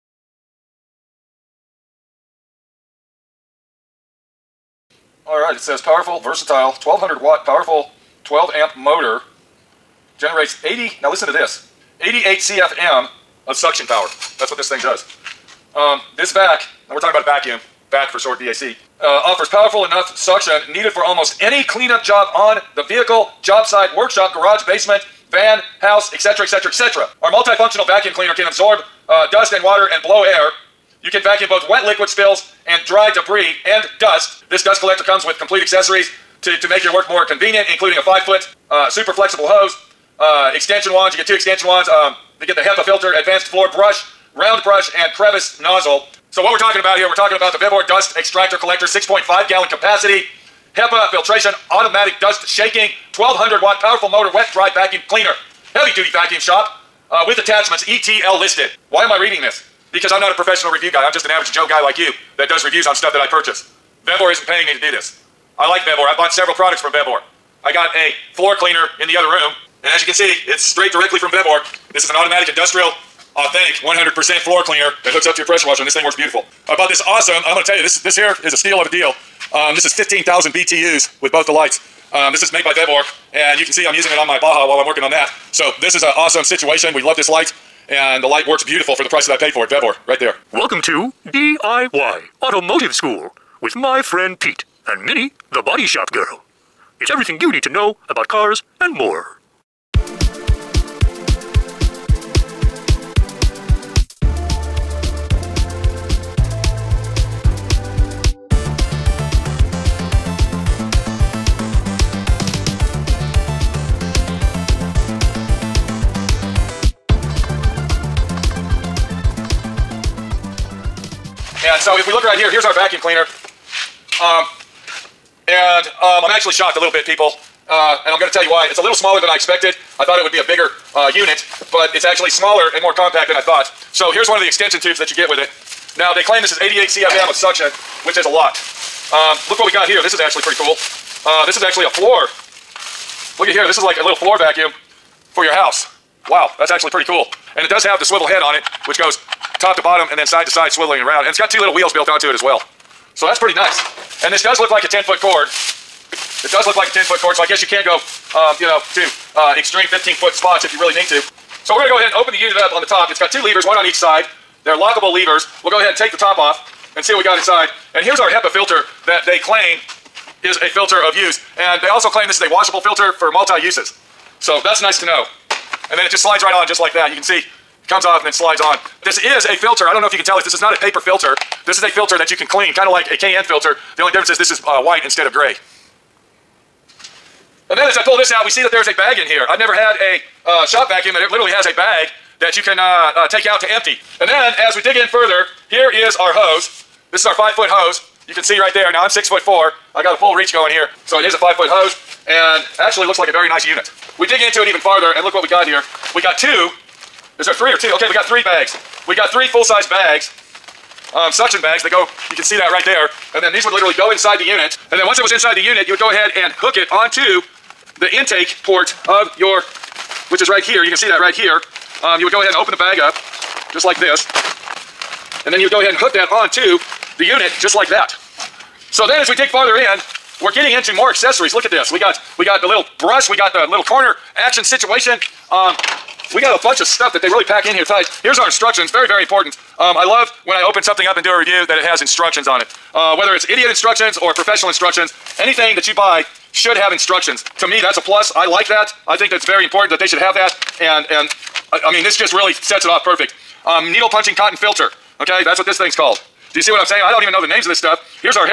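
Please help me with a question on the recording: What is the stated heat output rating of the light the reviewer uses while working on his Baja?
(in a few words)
15,000 BTUs.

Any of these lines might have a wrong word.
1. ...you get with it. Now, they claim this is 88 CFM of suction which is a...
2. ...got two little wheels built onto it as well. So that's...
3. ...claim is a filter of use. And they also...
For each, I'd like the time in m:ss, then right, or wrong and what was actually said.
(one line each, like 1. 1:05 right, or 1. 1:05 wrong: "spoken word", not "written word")
1. 2:15 right
2. 2:31 right
3. 2:49 right.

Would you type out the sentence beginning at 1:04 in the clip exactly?
Vevor isn't paying me to do this.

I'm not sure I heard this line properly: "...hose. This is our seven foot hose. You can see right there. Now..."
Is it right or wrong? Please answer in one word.
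wrong.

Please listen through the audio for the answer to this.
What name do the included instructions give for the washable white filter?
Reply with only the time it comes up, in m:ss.
4:13.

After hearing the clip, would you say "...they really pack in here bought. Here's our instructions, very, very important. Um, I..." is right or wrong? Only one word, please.
wrong.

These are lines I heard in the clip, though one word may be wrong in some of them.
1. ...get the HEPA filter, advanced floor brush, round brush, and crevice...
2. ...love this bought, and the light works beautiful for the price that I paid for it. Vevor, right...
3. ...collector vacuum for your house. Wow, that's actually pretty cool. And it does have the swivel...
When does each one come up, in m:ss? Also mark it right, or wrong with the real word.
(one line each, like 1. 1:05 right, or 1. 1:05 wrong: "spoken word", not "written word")
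1. 0:42 right
2. 1:27 wrong: "light", not "bought"
3. 2:24 wrong: "floor", not "collector".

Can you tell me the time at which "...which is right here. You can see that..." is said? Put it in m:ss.
3:40.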